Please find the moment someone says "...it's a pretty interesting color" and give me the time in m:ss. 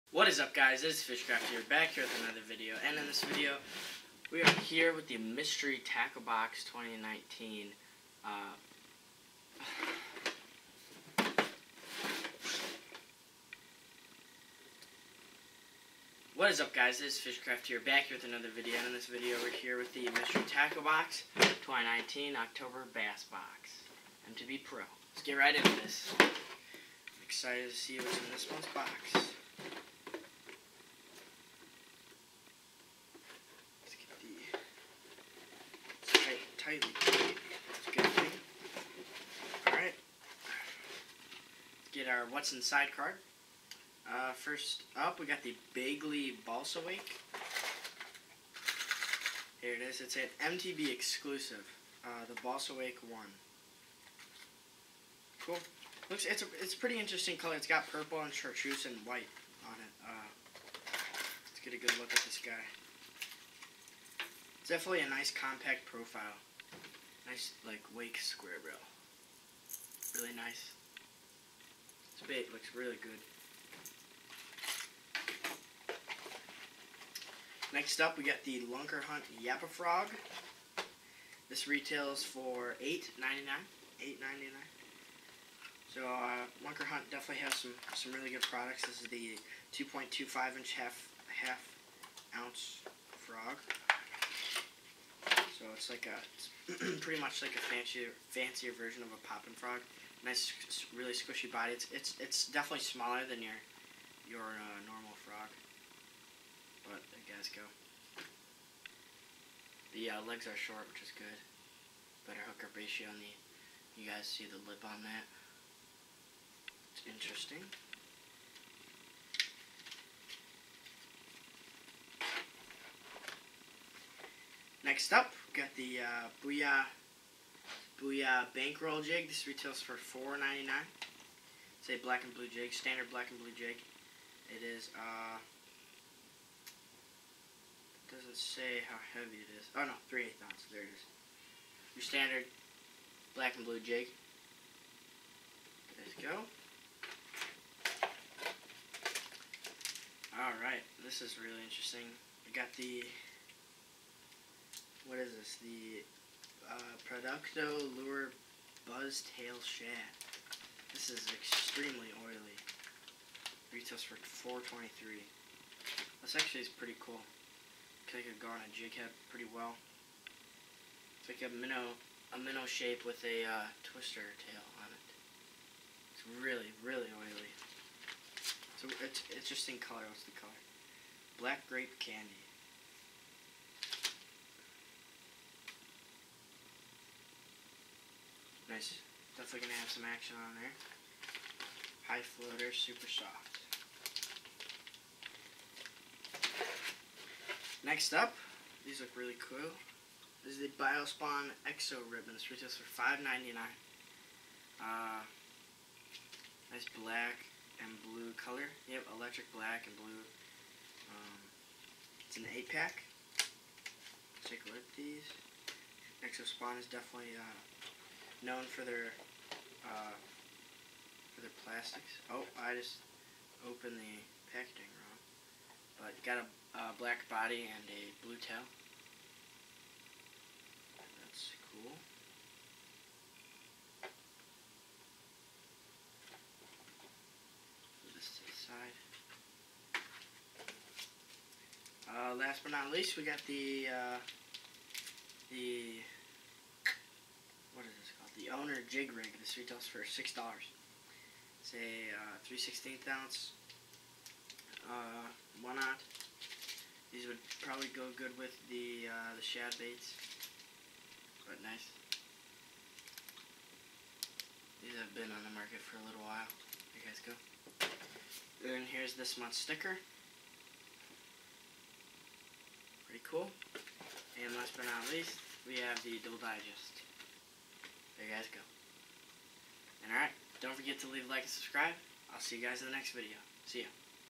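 0:56.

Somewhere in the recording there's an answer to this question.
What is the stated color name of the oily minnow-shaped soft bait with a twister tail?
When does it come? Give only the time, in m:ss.
3:01.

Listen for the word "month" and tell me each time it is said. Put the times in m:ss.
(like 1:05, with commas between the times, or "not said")
0:28, 4:29.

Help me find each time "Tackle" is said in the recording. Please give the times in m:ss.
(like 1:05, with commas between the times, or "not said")
0:05, 0:20.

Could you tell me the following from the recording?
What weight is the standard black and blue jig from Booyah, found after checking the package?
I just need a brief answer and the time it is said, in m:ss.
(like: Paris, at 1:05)
3/8 ounce, at 2:20.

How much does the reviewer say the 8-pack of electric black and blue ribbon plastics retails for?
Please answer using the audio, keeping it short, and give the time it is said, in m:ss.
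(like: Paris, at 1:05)
$5.99, at 3:22.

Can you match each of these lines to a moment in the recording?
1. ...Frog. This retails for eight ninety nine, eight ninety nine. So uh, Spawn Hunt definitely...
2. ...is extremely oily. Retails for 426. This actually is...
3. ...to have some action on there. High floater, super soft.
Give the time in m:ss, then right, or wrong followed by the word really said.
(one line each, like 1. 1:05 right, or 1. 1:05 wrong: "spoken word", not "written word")
1. 1:19 wrong: "Lunker", not "Spawn"
2. 2:41 wrong: "423", not "426"
3. 3:09 right.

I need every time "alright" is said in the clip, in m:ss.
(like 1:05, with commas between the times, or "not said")
0:39, 2:30, 4:40.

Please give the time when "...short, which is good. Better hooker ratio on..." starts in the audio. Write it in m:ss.
1:50.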